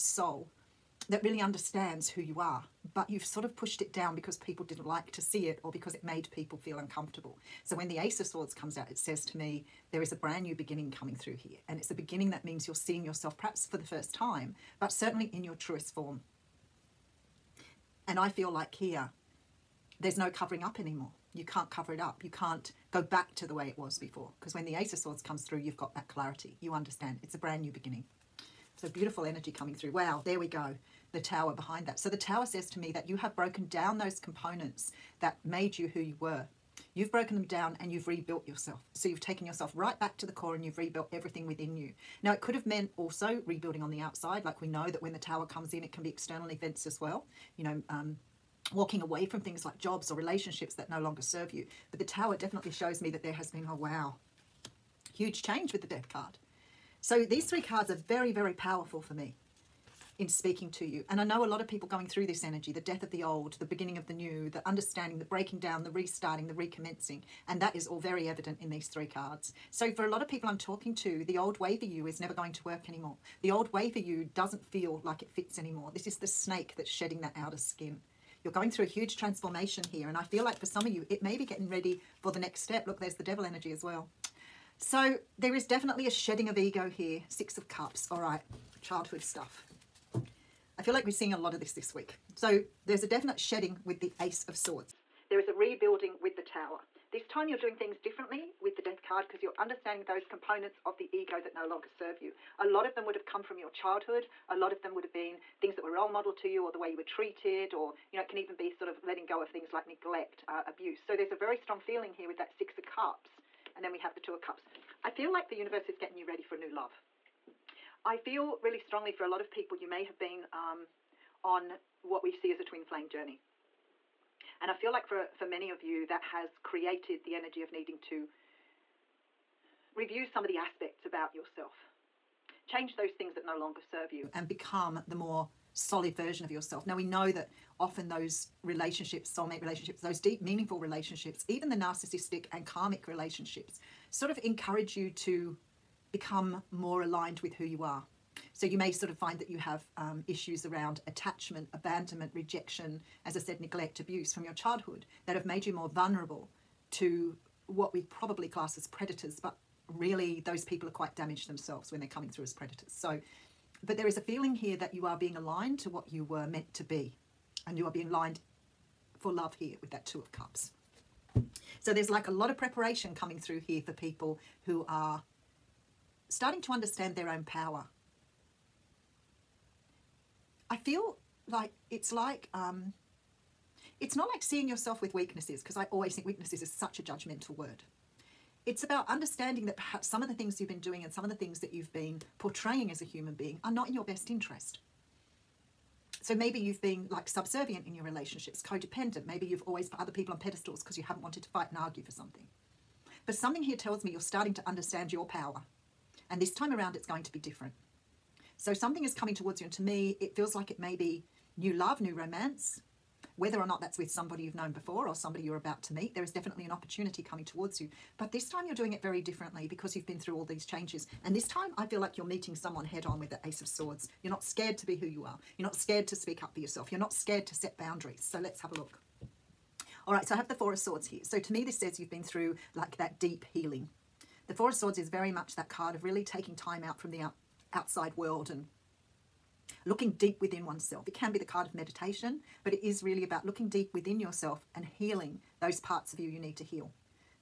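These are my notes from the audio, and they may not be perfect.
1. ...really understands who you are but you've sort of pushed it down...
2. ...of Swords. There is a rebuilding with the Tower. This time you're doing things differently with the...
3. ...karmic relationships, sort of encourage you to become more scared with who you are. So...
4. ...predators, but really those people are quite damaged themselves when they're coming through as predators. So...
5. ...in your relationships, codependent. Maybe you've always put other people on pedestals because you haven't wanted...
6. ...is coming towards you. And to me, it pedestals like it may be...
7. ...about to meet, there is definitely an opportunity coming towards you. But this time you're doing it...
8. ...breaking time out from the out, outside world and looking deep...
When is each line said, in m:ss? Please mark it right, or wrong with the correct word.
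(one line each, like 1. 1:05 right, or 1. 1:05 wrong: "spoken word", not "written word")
1. 0:01 right
2. 1:34 right
3. 2:22 wrong: "aligned", not "scared"
4. 2:38 right
5. 3:17 right
6. 3:29 wrong: "feels", not "pedestals"
7. 3:35 right
8. 3:56 wrong: "taking", not "breaking".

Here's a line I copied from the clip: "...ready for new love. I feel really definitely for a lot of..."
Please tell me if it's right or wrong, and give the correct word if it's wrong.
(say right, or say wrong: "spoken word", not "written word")
wrong: "strongly", not "definitely".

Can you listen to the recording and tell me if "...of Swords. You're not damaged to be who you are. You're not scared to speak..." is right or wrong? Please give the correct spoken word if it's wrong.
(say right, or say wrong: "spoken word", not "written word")
wrong: "scared", not "damaged".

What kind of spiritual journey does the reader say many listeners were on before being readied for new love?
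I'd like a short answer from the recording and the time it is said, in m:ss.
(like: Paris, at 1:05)
Twin flame journey, at 2:02.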